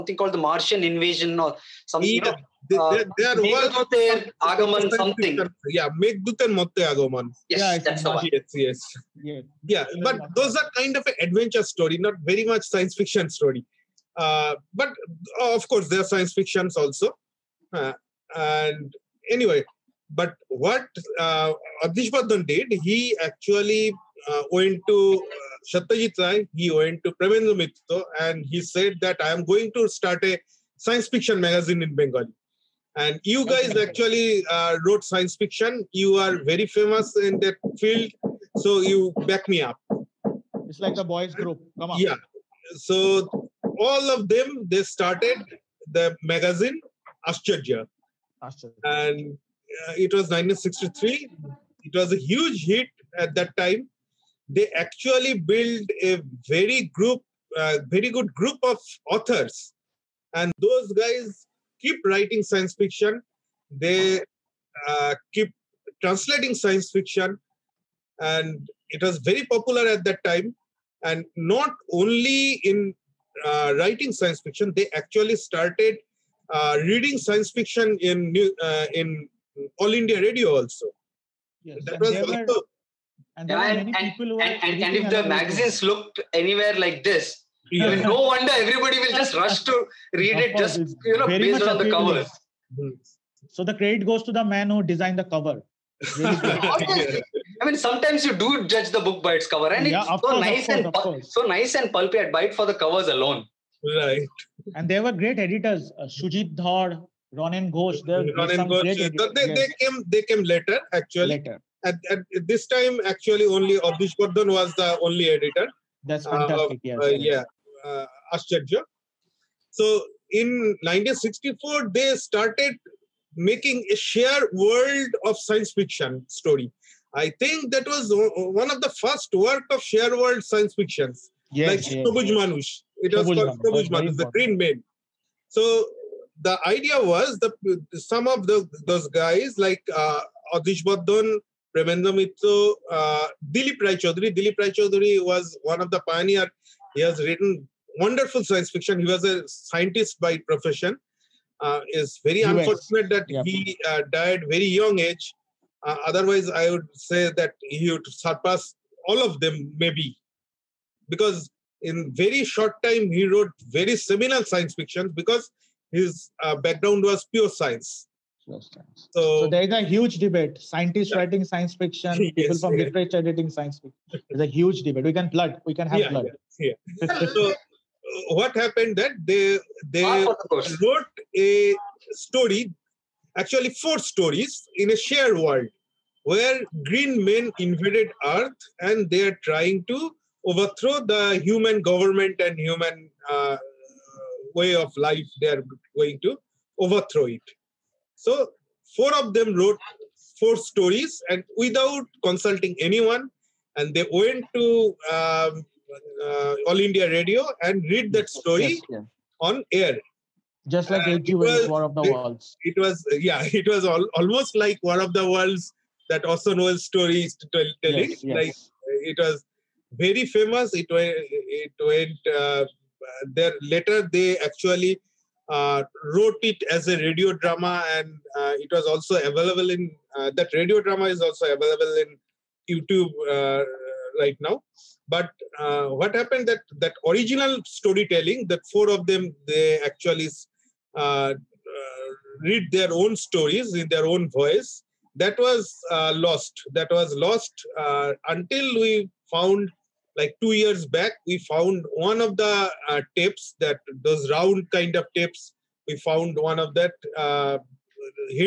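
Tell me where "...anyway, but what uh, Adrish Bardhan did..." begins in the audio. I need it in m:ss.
0:19.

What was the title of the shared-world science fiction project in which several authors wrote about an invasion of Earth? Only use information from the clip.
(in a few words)
Sobuj Manush.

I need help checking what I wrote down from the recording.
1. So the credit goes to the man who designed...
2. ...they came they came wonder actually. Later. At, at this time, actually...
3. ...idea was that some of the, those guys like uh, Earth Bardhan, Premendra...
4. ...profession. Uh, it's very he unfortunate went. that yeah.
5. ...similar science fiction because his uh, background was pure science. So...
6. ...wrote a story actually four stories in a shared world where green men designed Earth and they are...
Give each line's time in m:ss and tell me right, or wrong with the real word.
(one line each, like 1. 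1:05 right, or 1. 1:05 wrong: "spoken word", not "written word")
1. 1:33 right
2. 1:49 wrong: "later", not "wonder"
3. 2:16 wrong: "Adrish", not "Earth"
4. 2:30 right
5. 2:43 right
6. 3:00 wrong: "invaded", not "designed".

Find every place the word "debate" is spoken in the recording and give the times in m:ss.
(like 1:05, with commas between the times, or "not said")
2:50, 2:54.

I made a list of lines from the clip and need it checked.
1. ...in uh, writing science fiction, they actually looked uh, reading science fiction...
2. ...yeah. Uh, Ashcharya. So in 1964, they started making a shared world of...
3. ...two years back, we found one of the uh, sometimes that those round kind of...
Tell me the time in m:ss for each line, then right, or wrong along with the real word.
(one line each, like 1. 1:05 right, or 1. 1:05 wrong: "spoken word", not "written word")
1. 1:12 wrong: "started", not "looked"
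2. 1:57 right
3. 4:10 wrong: "tapes", not "sometimes".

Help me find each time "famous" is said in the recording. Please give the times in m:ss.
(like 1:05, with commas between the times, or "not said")
0:36, 3:40.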